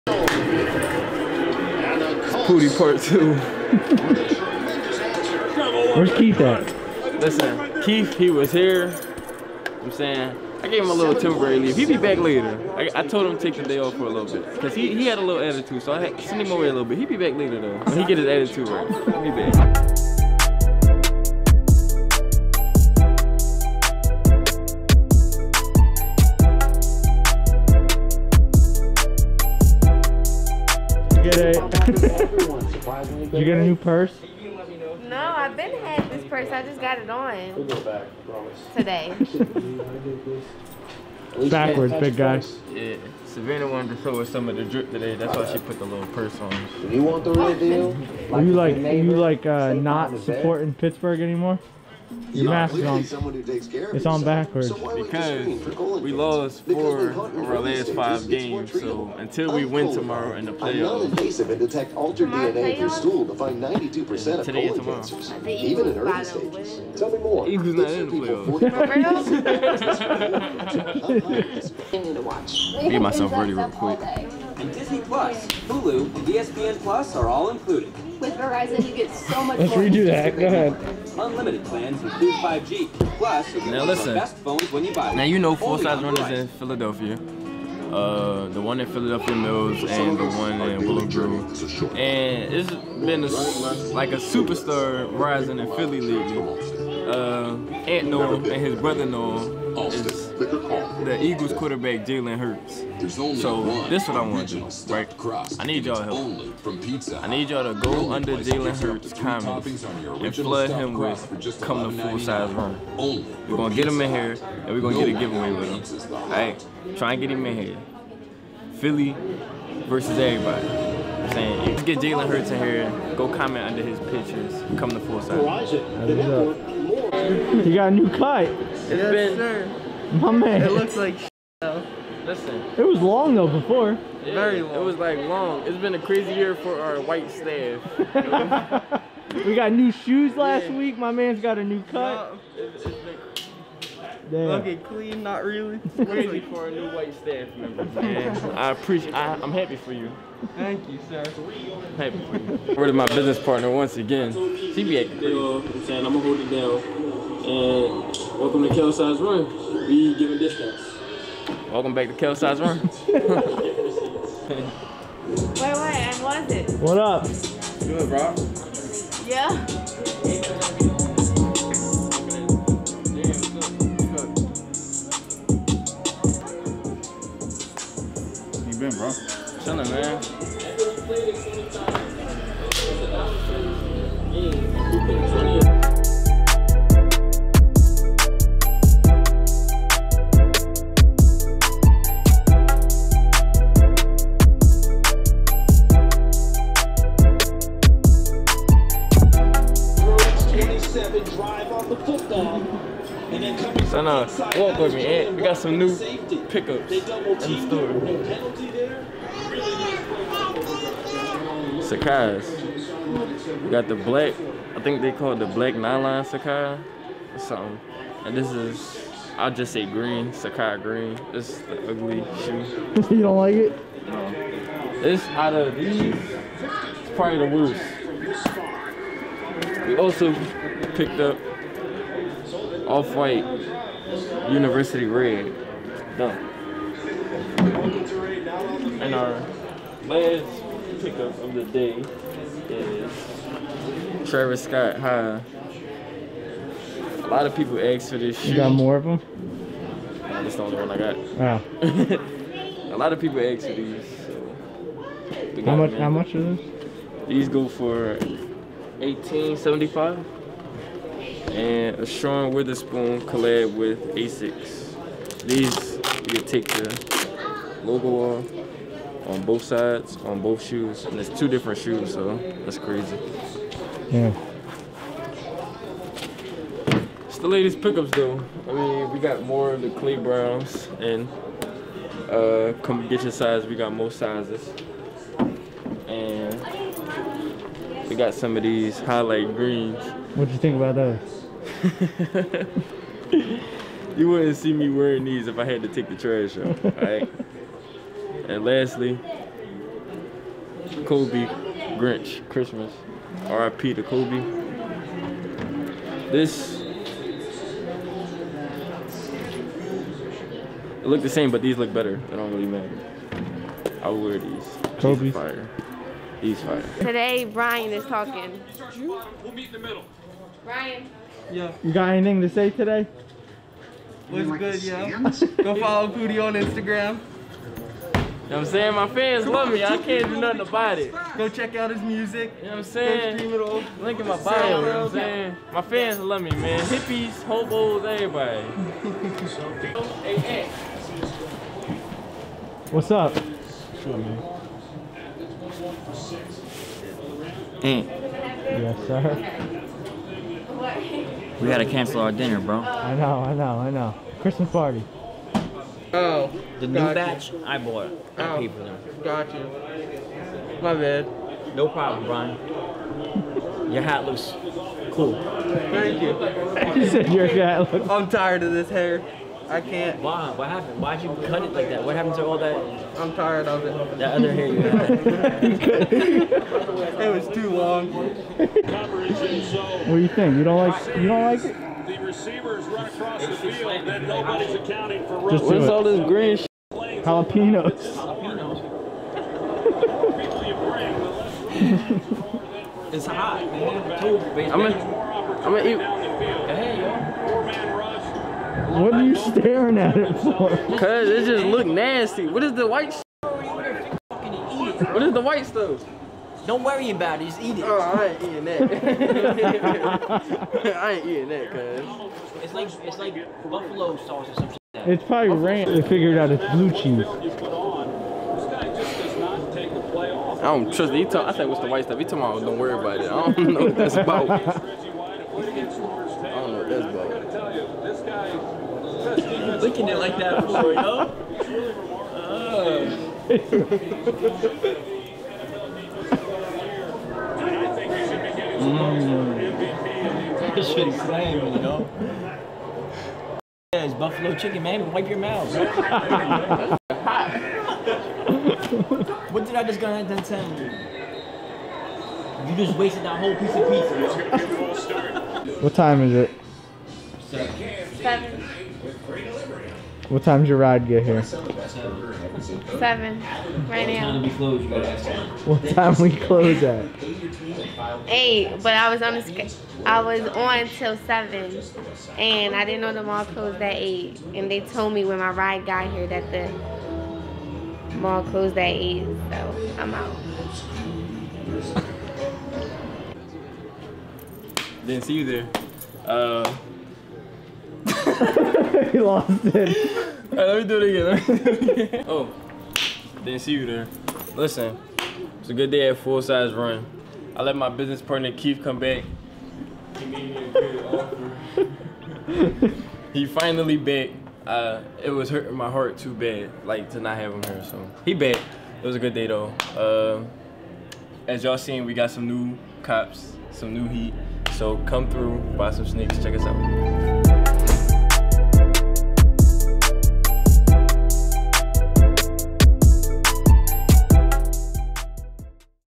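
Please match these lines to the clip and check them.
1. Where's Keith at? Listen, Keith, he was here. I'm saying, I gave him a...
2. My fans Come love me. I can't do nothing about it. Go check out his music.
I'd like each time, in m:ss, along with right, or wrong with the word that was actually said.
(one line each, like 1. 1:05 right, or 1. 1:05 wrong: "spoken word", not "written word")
1. 0:05 right
2. 5:28 right.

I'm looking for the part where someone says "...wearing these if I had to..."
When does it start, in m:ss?
4:54.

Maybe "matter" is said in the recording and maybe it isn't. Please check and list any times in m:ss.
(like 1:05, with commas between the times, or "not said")
5:12.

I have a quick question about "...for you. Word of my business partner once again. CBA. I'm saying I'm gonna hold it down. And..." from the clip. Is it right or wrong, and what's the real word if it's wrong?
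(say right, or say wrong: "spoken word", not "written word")
right.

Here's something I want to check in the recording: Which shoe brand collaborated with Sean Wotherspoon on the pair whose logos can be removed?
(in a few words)
Asics.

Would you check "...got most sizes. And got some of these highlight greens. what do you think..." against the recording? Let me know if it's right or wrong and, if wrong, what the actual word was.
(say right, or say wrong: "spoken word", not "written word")
right.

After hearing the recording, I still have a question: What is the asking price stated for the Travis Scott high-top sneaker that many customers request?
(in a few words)
1875.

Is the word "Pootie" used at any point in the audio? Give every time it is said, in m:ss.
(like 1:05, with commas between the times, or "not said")
0:02, 5:26.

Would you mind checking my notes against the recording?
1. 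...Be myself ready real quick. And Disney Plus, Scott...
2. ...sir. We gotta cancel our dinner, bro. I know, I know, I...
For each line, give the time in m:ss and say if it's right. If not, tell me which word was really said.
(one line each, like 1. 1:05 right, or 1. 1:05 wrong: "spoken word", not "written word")
1. 1:12 wrong: "Hulu", not "Scott"
2. 5:49 right.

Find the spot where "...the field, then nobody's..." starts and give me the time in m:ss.
6:23.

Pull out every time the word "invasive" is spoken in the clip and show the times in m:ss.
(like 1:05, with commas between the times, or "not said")
1:00.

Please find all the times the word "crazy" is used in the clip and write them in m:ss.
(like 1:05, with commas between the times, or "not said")
2:15, 2:26, 4:32.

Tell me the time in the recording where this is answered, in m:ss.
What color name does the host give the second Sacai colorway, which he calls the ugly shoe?
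3:40.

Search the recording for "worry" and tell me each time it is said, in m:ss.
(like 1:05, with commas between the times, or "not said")
6:46, 7:02.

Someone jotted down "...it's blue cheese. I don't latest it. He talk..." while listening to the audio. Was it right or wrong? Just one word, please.
wrong.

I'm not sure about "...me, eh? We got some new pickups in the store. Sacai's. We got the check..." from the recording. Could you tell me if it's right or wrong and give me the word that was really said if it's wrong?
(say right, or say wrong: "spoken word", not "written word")
wrong: "black", not "check".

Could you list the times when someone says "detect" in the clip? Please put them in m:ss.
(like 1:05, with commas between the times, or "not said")
1:01.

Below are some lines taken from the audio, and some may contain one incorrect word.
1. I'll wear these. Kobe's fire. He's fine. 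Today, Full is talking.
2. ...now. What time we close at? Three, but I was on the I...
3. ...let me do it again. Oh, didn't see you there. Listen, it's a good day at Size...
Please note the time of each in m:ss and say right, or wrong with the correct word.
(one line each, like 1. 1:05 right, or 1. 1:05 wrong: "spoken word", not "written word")
1. 5:14 wrong: "Brian", not "Full"
2. 7:44 wrong: "Eight", not "Three"
3. 8:10 wrong: "Full", not "Size".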